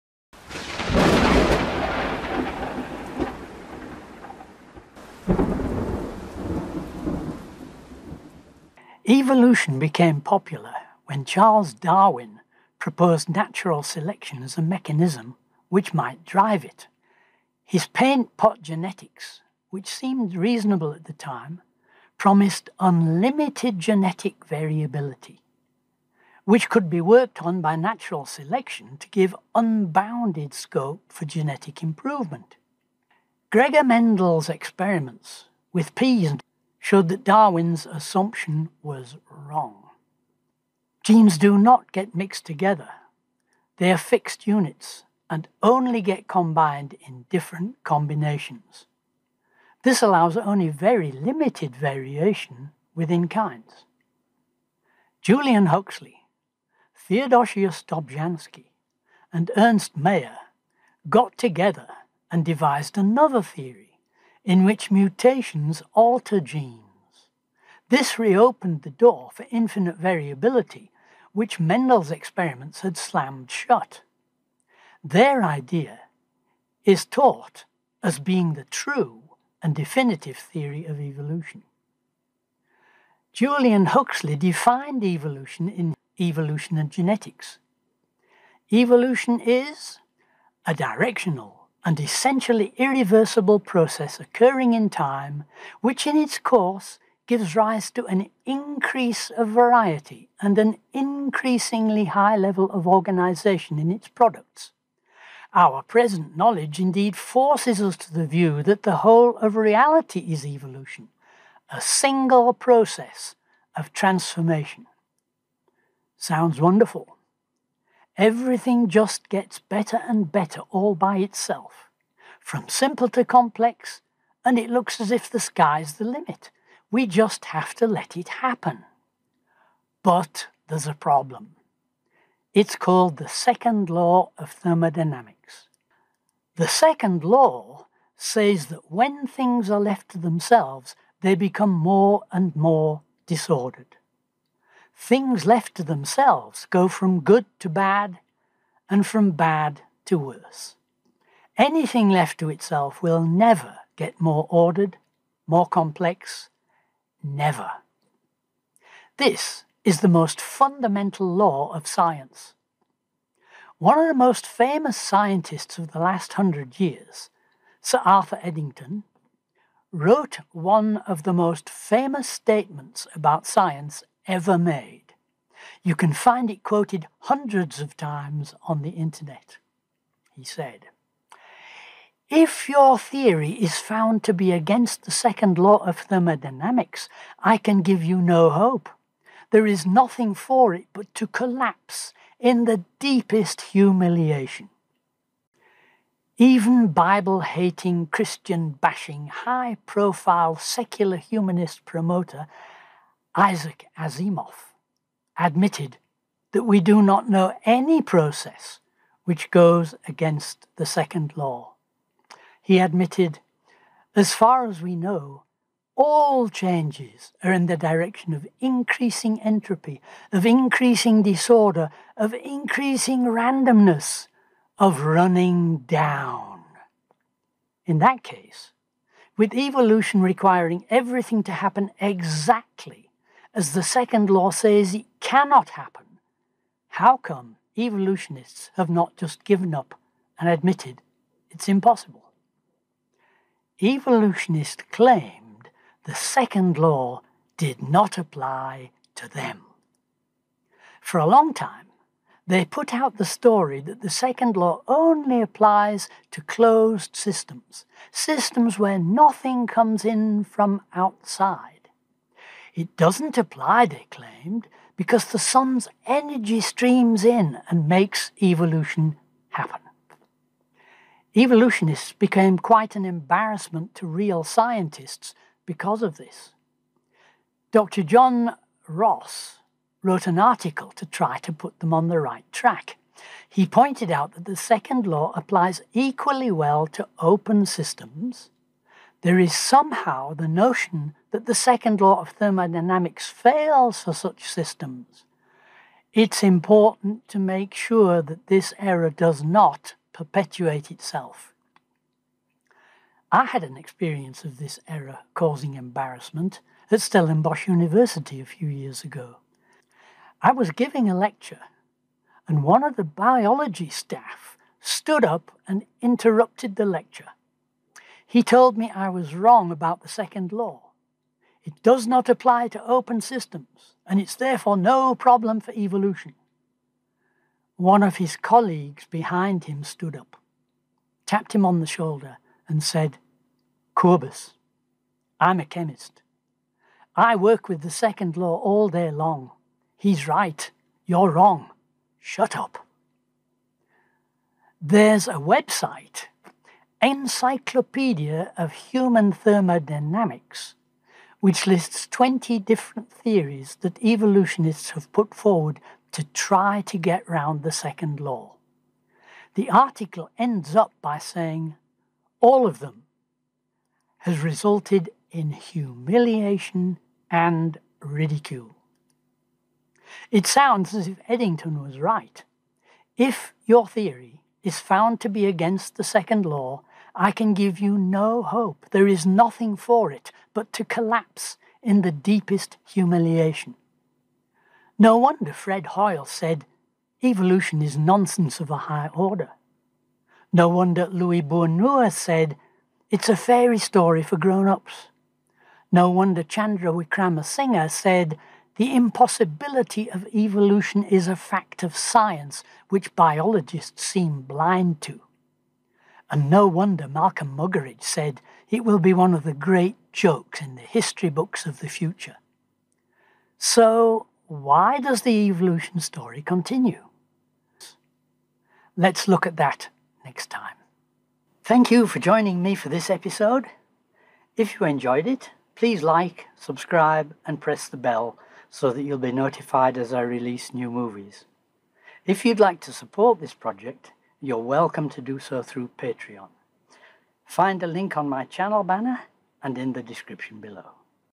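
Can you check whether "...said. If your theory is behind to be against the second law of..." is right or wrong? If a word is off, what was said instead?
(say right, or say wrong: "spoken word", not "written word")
wrong: "found", not "behind".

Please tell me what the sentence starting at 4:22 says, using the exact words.
It doesn't apply, they claimed, because the sun's energy streams in and makes evolution happen.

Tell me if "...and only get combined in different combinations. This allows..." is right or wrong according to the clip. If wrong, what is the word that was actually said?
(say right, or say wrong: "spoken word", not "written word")
right.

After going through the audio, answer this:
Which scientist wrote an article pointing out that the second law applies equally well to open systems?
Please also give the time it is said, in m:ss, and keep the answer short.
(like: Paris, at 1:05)
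John Ross, at 4:37.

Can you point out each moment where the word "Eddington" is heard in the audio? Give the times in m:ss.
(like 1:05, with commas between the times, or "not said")
2:48, 6:11.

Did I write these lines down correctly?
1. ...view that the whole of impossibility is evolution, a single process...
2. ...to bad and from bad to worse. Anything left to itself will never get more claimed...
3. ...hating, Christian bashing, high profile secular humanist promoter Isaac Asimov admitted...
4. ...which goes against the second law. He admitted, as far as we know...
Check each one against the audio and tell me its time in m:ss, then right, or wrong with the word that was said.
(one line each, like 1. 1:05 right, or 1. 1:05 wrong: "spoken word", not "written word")
1. 1:48 wrong: "reality", not "impossibility"
2. 2:27 wrong: "ordered", not "claimed"
3. 3:17 right
4. 3:29 right.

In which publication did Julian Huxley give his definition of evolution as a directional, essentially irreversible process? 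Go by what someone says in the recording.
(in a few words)
Evolution and Genetics.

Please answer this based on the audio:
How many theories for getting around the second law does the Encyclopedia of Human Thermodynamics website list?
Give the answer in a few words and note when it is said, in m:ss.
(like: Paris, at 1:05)
20, at 5:52.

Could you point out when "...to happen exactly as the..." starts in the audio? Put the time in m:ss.
3:51.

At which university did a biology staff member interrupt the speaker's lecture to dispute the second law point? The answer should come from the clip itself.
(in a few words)
Stellenbosch University.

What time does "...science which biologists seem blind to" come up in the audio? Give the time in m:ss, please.
6:41.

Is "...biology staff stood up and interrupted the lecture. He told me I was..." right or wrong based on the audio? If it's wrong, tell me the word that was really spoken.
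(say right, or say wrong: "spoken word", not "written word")
right.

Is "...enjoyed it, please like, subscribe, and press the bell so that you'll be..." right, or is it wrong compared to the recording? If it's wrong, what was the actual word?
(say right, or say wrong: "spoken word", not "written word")
right.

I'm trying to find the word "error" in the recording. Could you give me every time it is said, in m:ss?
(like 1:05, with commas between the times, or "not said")
4:58, 5:04.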